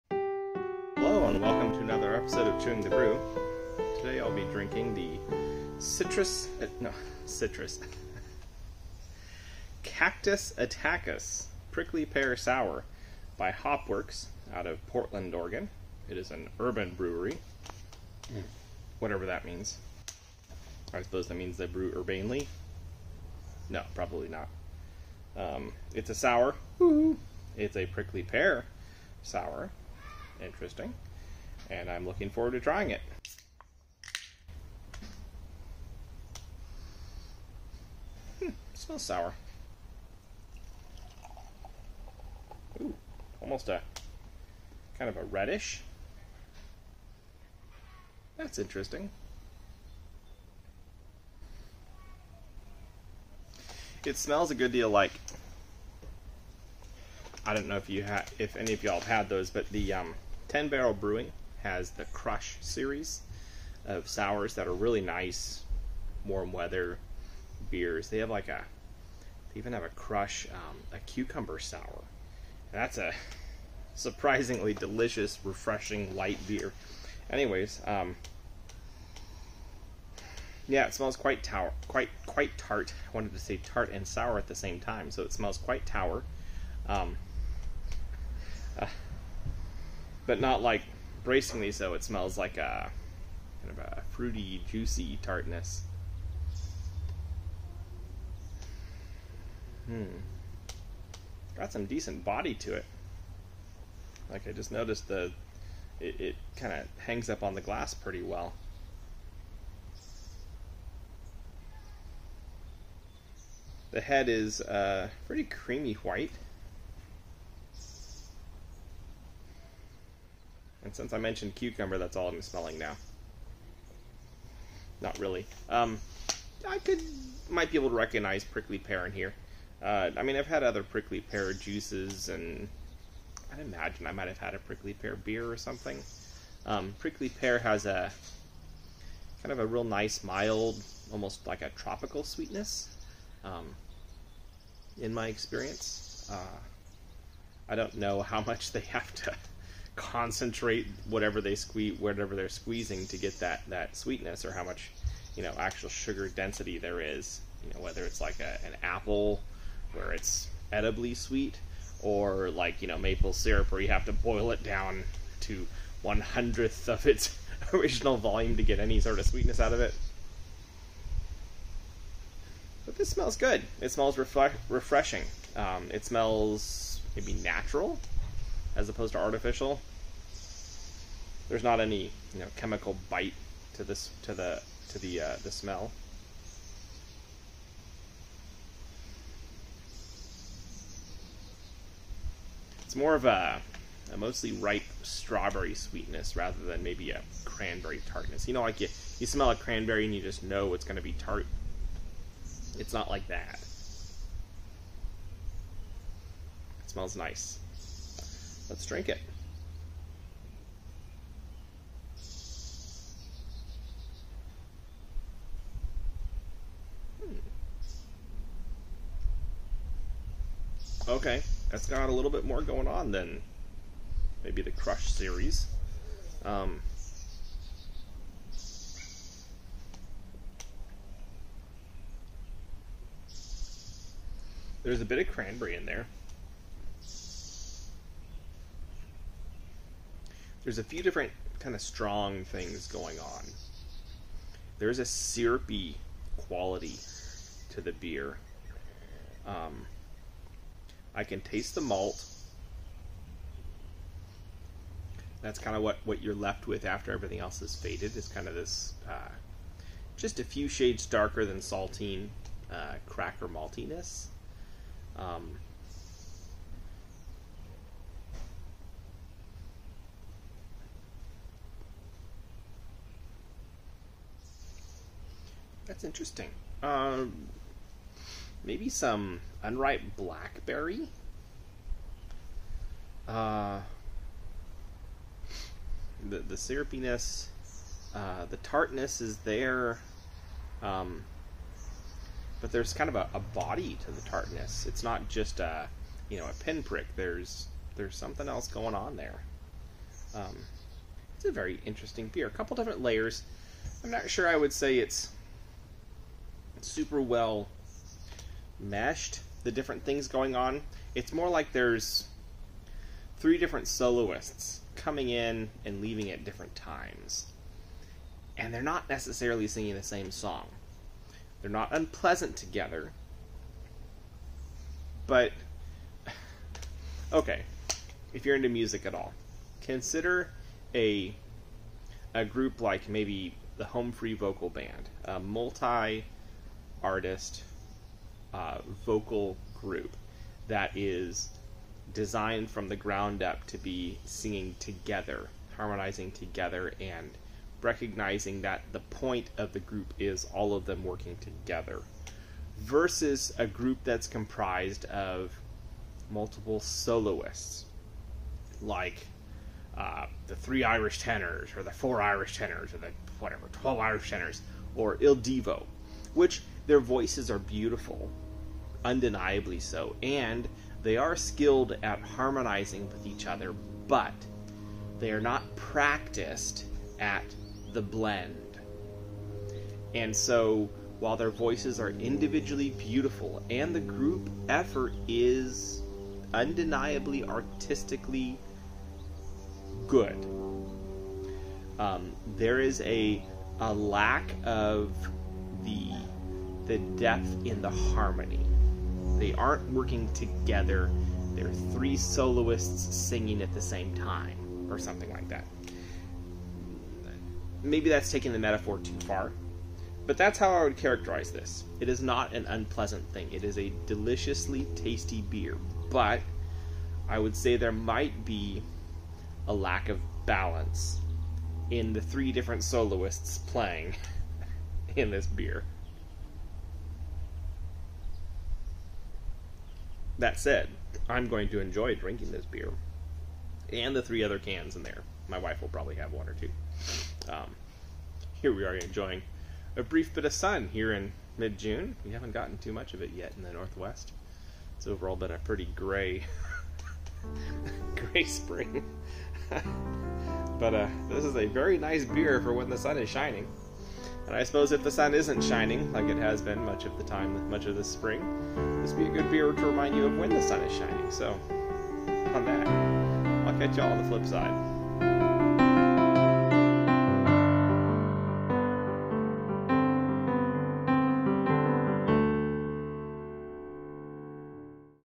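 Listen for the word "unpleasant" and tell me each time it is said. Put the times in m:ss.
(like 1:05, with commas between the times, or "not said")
5:21, 6:52.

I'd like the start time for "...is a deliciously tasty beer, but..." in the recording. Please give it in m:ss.
6:53.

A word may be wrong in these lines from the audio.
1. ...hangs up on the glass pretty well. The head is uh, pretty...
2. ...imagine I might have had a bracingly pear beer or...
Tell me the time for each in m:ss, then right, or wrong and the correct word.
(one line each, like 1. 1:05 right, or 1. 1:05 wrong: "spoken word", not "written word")
1. 1:46 right
2. 2:13 wrong: "prickly", not "bracingly".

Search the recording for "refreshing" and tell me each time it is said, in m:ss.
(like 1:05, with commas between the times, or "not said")
1:15, 2:54.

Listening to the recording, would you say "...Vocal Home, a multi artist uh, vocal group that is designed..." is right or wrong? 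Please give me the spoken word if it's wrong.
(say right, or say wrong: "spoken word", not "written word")
wrong: "Band", not "Home".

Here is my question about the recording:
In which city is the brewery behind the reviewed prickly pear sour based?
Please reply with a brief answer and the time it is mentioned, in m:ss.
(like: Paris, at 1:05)
Portland, Oregon, at 0:14.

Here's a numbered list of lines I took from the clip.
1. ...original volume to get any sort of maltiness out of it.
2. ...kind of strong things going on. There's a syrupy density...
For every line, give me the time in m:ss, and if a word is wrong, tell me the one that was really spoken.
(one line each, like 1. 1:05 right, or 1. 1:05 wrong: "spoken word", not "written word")
1. 2:47 wrong: "sweetness", not "maltiness"
2. 4:01 wrong: "quality", not "density".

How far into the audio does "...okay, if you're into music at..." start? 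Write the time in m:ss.
5:27.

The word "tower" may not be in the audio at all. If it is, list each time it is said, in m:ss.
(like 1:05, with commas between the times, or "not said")
1:21, 1:25.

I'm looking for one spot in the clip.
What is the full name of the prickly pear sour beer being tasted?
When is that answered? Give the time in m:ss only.
0:09.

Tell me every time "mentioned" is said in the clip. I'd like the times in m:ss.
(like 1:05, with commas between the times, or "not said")
2:01.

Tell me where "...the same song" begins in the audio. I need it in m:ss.
5:19.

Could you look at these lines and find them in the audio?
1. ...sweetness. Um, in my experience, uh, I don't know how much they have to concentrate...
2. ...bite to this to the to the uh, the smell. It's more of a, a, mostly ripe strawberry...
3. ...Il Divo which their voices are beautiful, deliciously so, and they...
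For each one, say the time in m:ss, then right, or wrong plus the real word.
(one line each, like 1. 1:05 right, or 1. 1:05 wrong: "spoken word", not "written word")
1. 2:22 right
2. 3:03 right
3. 6:05 wrong: "undeniably", not "deliciously".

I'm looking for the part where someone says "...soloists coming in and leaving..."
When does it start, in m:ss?
5:13.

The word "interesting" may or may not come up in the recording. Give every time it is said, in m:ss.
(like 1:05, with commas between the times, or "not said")
0:30, 0:48, 4:36, 5:01.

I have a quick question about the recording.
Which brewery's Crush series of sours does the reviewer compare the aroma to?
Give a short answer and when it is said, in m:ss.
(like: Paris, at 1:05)
Ten Barrel Brewing, at 1:00.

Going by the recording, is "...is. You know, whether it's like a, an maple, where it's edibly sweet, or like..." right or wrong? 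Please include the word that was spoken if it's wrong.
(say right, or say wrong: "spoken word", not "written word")
wrong: "apple", not "maple".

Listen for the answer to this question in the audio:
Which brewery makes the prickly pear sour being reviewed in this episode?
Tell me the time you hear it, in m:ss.
0:13.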